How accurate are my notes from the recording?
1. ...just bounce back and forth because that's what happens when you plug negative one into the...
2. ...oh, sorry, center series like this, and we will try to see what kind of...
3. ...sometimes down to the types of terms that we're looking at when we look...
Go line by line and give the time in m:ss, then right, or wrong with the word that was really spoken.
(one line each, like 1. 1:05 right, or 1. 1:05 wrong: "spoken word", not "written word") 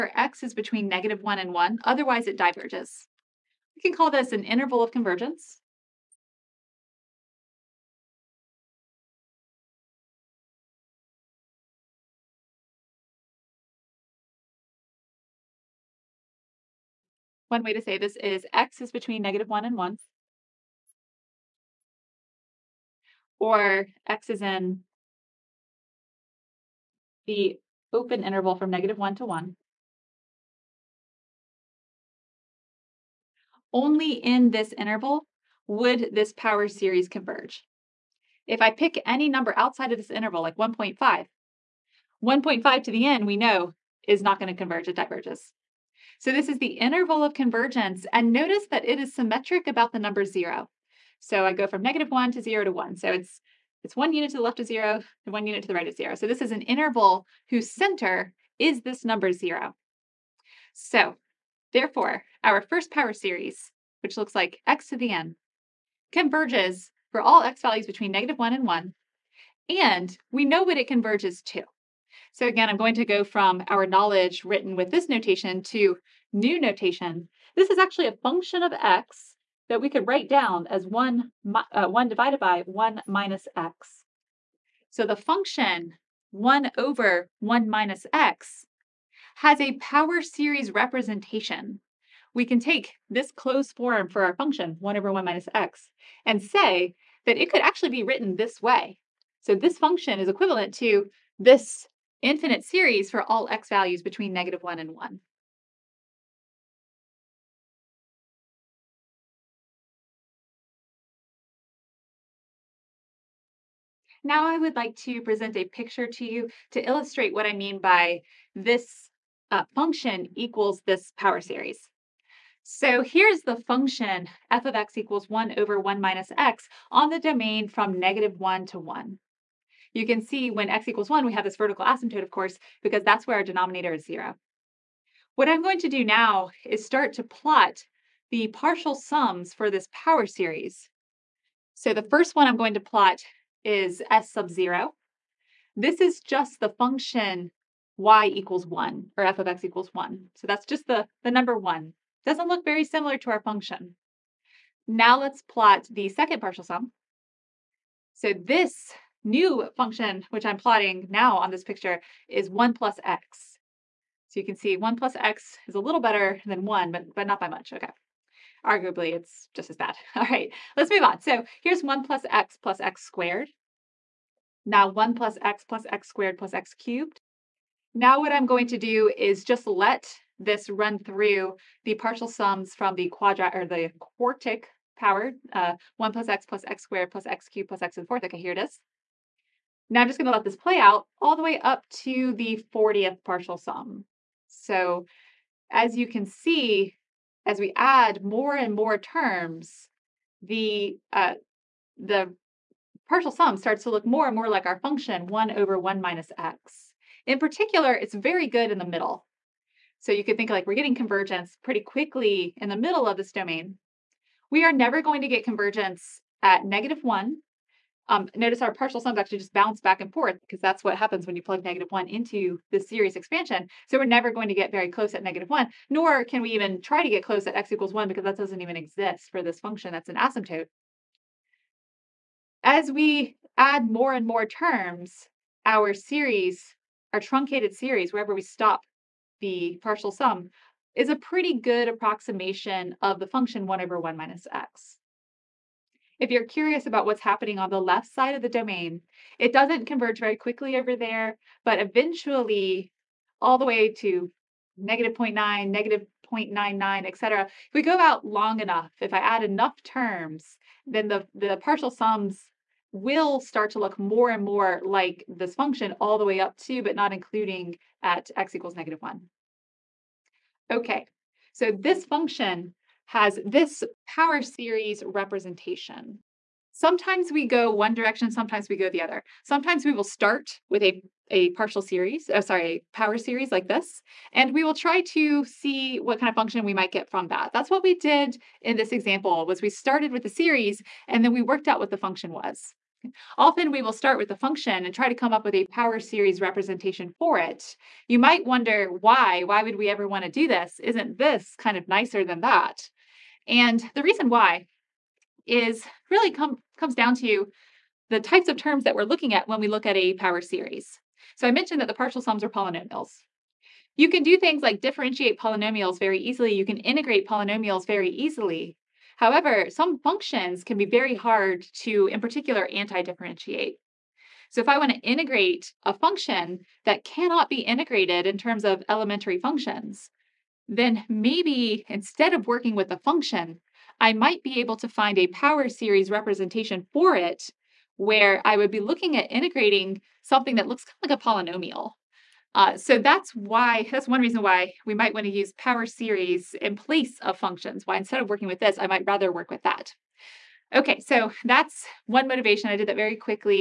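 1. 3:39 right
2. 4:42 wrong: "power", not "center"
3. 5:06 wrong: "comes", not "sometimes".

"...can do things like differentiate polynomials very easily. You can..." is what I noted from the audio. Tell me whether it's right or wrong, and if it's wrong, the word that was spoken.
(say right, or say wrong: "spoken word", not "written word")
right.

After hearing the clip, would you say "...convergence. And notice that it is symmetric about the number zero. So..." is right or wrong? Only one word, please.
right.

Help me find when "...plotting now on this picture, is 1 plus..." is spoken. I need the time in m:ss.
2:40.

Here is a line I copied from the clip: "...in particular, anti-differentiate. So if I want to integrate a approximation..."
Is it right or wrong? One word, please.
wrong.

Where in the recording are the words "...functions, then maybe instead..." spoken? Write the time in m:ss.
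5:29.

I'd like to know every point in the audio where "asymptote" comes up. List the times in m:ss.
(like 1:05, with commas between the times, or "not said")
2:11, 3:50.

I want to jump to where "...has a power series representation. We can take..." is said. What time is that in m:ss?
1:29.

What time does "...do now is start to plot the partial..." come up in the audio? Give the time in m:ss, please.
2:15.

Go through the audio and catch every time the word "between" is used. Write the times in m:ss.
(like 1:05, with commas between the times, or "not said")
0:00, 0:18, 1:07, 1:44.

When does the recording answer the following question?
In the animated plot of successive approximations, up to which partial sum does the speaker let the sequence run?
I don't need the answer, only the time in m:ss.
3:12.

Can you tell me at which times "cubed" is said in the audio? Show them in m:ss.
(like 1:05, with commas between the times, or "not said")
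2:56, 3:07.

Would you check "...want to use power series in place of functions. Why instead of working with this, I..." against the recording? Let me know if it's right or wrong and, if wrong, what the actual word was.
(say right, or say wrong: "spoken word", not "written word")
right.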